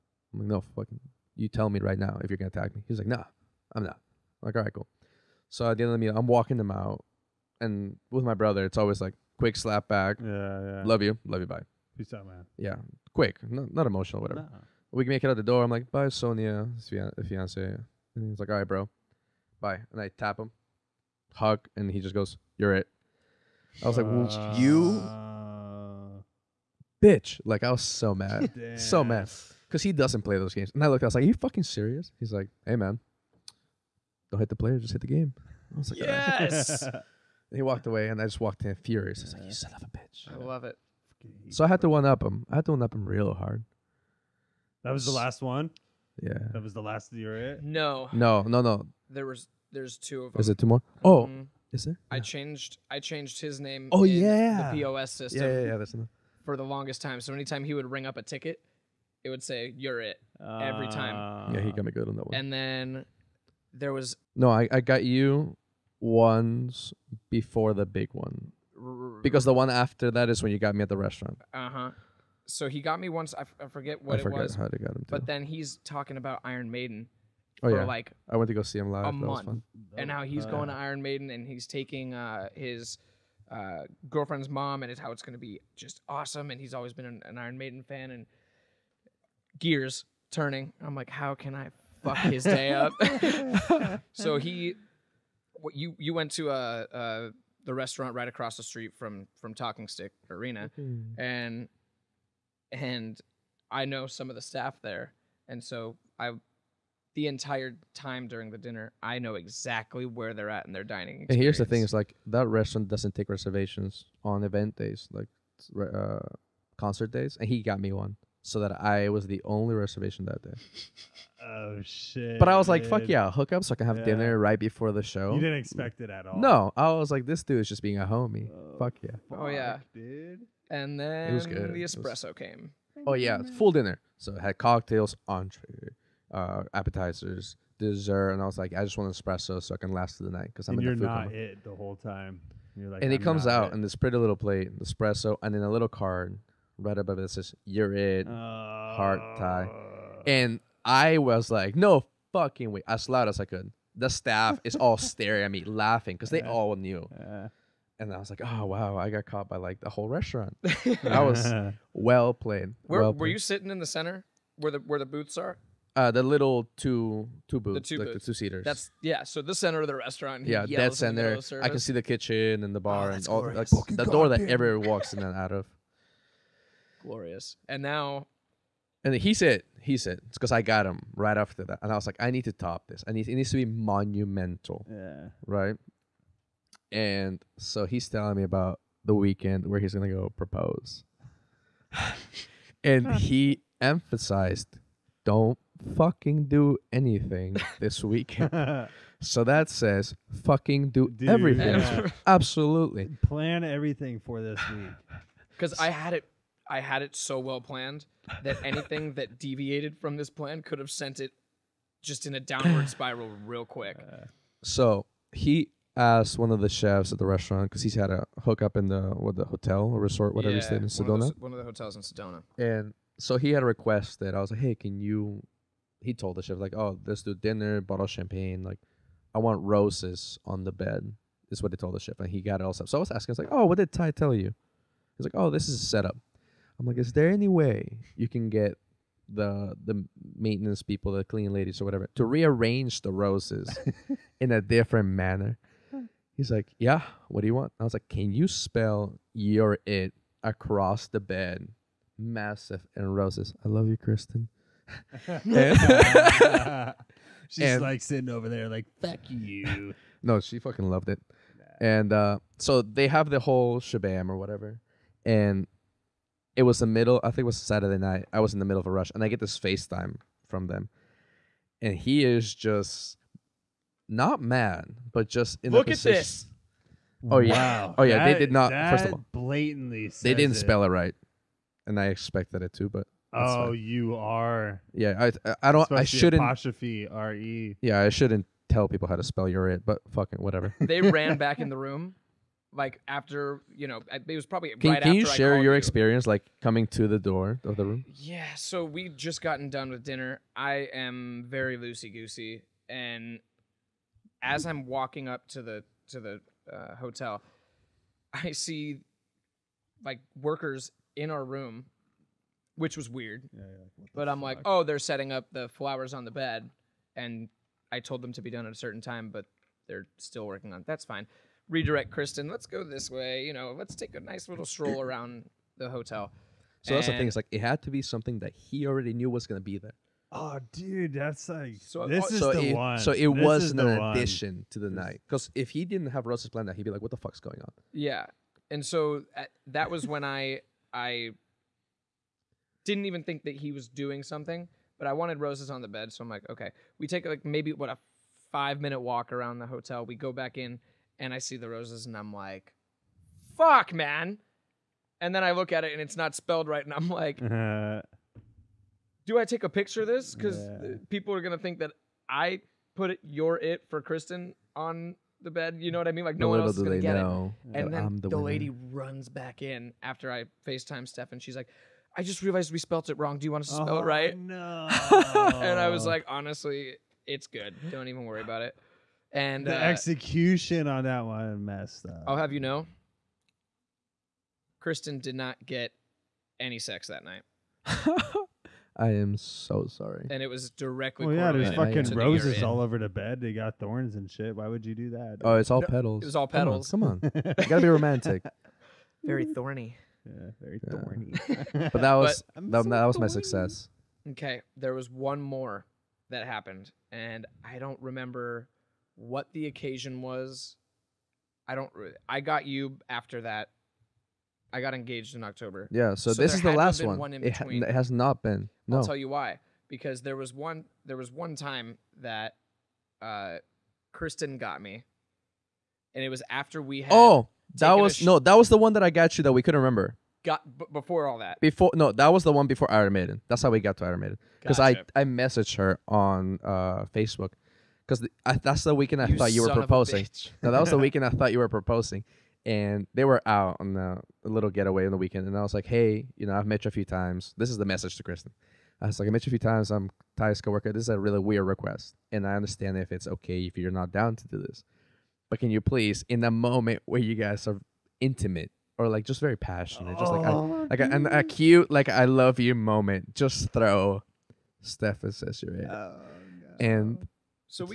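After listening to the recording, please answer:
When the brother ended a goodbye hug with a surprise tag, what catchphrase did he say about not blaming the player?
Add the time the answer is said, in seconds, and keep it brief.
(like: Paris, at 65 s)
Don't hit the player, just hit the game, at 34 s.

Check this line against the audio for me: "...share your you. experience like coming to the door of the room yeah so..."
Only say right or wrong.
right.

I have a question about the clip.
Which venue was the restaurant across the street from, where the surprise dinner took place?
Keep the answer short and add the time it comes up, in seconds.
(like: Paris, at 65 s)
Talking Stick Arena, at 99 s.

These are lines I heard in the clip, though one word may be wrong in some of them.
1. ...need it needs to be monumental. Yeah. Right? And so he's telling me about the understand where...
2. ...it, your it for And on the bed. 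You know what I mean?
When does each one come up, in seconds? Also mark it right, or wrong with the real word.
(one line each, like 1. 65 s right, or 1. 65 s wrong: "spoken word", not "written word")
1. 183 s wrong: "weekend", not "understand"
2. 363 s wrong: "Kristen", not "And".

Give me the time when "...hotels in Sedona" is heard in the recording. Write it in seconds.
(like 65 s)
221 s.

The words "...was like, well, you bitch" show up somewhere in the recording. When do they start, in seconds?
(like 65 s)
23 s.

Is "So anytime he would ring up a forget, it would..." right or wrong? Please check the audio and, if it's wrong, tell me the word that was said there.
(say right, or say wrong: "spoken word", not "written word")
wrong: "ticket", not "forget".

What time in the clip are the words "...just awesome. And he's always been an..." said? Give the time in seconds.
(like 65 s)
85 s.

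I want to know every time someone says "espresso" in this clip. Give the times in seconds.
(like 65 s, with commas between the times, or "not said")
131 s, 139 s, 144 s.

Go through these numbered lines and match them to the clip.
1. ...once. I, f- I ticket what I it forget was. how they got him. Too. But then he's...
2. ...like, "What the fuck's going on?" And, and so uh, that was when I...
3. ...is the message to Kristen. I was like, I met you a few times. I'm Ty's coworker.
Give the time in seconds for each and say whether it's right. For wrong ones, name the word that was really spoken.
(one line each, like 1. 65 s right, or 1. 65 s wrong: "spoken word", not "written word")
1. 73 s wrong: "forget", not "ticket"
2. 336 s wrong: "Yeah", not "And"
3. 447 s right.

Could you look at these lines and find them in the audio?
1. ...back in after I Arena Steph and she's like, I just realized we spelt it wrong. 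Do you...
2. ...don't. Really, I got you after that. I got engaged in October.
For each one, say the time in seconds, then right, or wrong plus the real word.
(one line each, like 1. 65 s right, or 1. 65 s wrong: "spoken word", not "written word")
1. 369 s wrong: "FaceTime", not "Arena"
2. 411 s right.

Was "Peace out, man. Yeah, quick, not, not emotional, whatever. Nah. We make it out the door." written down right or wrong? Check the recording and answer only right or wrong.
right.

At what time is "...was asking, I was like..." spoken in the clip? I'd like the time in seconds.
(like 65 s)
232 s.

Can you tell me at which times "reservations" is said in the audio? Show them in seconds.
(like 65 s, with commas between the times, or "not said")
113 s, 119 s.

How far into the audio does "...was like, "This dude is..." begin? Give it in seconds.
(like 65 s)
126 s.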